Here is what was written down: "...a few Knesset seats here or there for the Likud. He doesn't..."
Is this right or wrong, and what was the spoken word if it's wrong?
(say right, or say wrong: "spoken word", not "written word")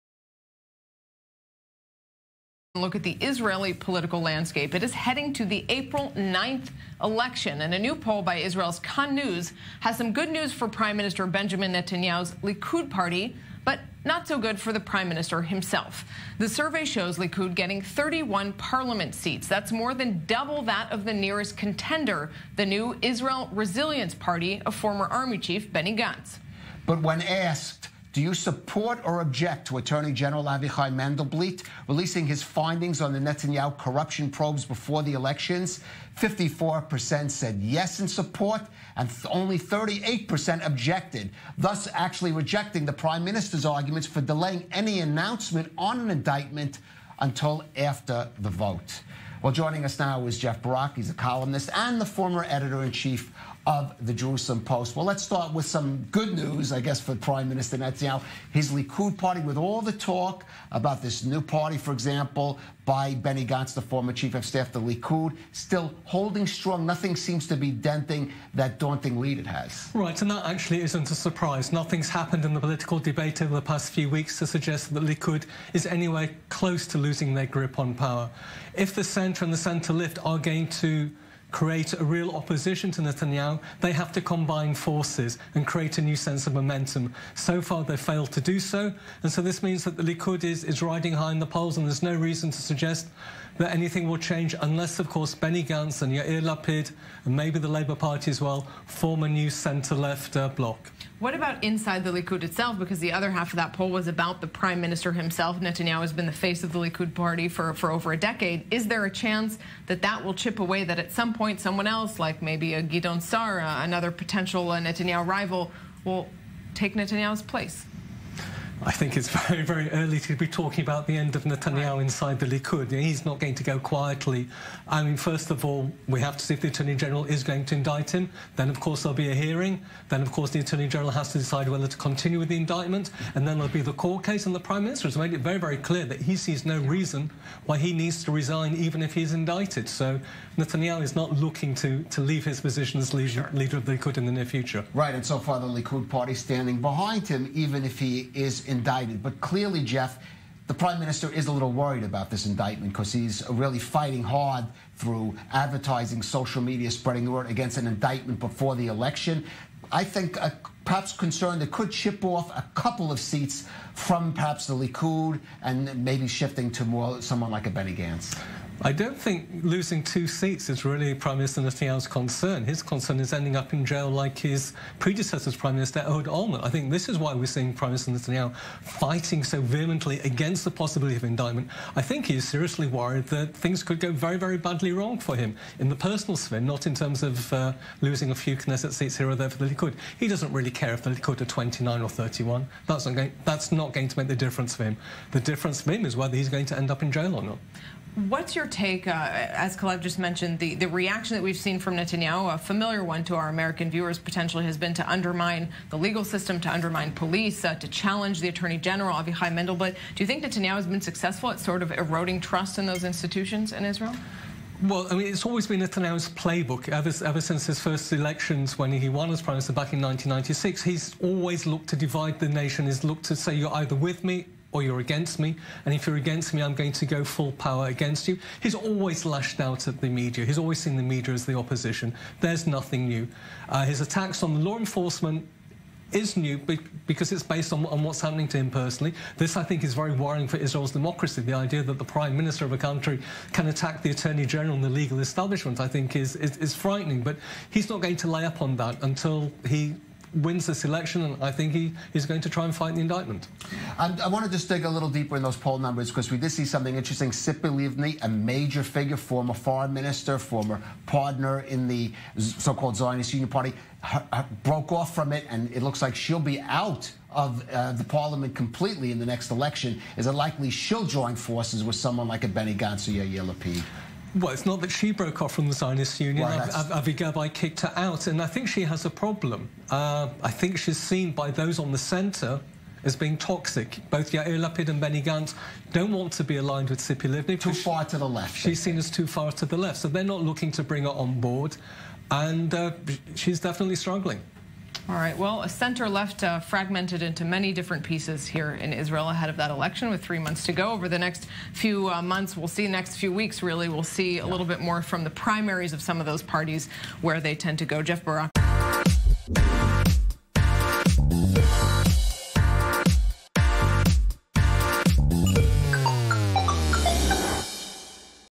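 right.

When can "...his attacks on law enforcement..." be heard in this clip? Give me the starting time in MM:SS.
03:53.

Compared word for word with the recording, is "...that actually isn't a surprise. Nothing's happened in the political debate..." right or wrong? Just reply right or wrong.
right.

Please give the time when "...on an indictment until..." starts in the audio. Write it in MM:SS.
00:45.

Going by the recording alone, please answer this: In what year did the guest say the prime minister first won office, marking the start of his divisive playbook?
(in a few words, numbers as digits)
1996.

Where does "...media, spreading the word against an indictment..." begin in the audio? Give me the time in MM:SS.
02:36.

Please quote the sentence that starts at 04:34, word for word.
Well, it's not that she broke off from the Zionist Union.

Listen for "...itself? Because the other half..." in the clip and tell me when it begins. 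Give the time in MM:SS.
01:42.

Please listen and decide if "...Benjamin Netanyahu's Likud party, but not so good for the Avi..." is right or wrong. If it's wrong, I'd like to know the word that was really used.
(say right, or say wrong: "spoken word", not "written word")
wrong: "Prime", not "Avi".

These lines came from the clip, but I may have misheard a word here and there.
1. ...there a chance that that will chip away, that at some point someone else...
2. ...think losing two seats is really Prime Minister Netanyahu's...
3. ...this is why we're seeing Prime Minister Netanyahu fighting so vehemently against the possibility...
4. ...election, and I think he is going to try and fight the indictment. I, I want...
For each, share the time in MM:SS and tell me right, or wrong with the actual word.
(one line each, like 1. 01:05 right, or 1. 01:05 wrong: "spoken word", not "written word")
1. 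01:48 right
2. 02:49 right
3. 02:56 right
4. 04:10 right.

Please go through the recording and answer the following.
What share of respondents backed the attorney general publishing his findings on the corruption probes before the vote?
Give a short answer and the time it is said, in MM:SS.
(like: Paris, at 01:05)
54%, at 00:36.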